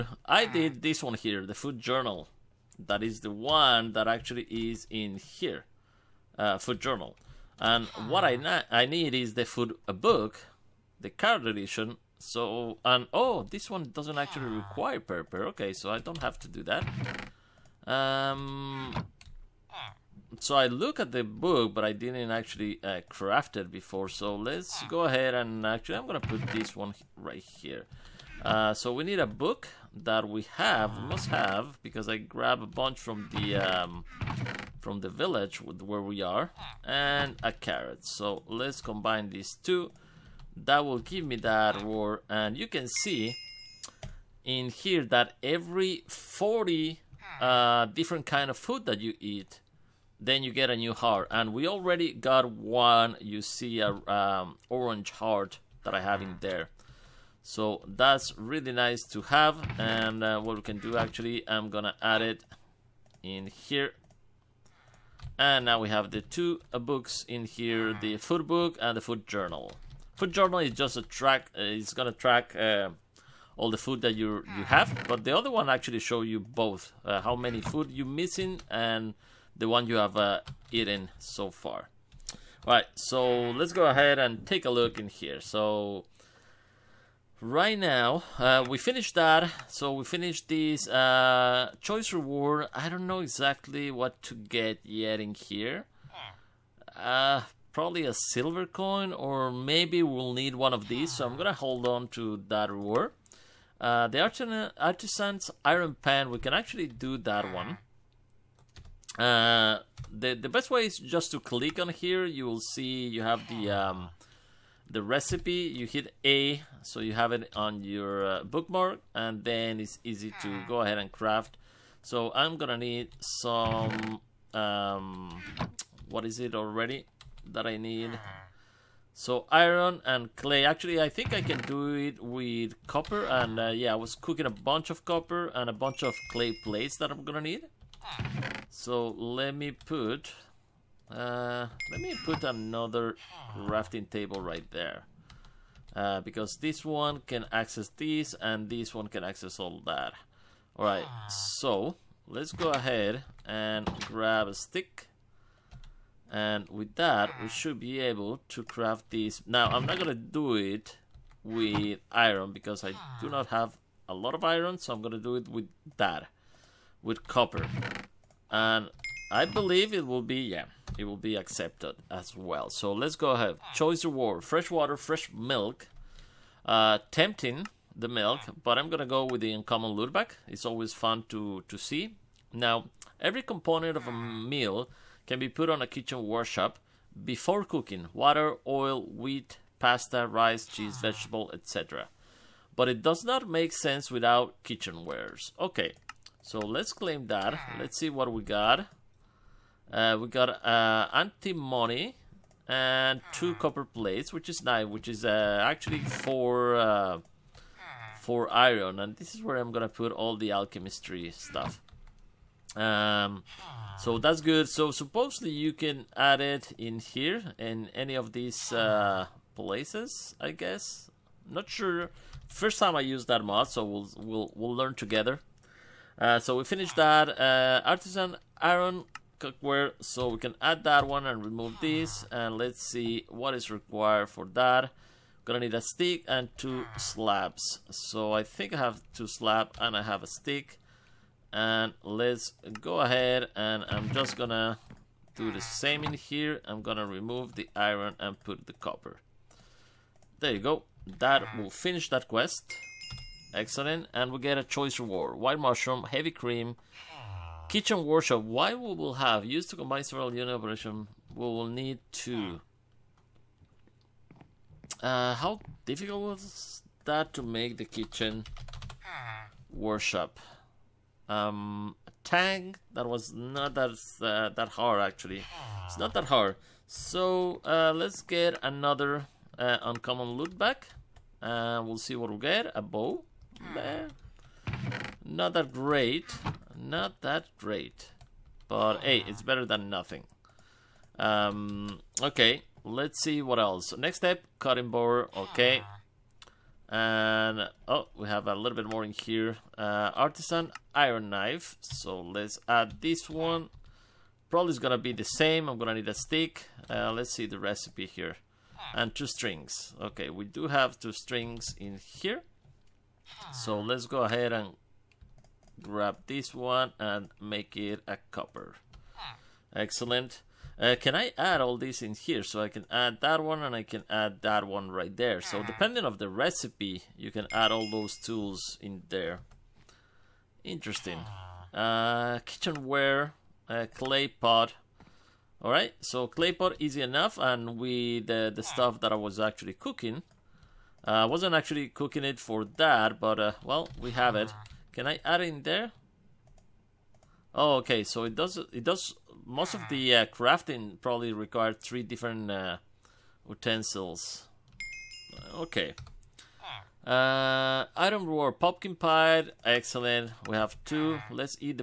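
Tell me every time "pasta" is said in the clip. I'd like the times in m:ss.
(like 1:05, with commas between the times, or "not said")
3:09.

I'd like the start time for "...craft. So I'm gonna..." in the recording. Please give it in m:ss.
2:01.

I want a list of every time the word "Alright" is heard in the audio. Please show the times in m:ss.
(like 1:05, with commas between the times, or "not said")
1:22, 2:30.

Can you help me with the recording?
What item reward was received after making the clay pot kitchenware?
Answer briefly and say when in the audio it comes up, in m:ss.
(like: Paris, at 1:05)
pumpkin pie, at 5:58.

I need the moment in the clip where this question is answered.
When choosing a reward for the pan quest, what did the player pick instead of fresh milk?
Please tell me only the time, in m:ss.
2:59.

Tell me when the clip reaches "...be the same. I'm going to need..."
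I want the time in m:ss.
5:04.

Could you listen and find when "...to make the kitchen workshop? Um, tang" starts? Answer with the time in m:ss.
4:27.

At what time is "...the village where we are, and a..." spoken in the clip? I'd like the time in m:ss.
0:35.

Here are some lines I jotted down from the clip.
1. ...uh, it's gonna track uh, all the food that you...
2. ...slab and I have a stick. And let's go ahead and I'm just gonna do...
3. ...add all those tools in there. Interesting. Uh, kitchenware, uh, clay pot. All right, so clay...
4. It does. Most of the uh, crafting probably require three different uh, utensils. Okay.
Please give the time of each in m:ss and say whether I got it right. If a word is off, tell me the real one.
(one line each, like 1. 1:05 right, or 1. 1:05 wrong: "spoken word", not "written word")
1. 1:11 right
2. 3:59 right
3. 5:27 right
4. 5:48 right.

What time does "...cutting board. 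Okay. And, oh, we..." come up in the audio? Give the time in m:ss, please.
4:54.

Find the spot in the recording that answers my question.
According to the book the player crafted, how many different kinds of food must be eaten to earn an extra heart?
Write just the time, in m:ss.
0:46.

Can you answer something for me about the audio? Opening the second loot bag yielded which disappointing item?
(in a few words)
A bow.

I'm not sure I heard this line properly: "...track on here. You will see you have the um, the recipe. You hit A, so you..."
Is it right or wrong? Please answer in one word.
wrong.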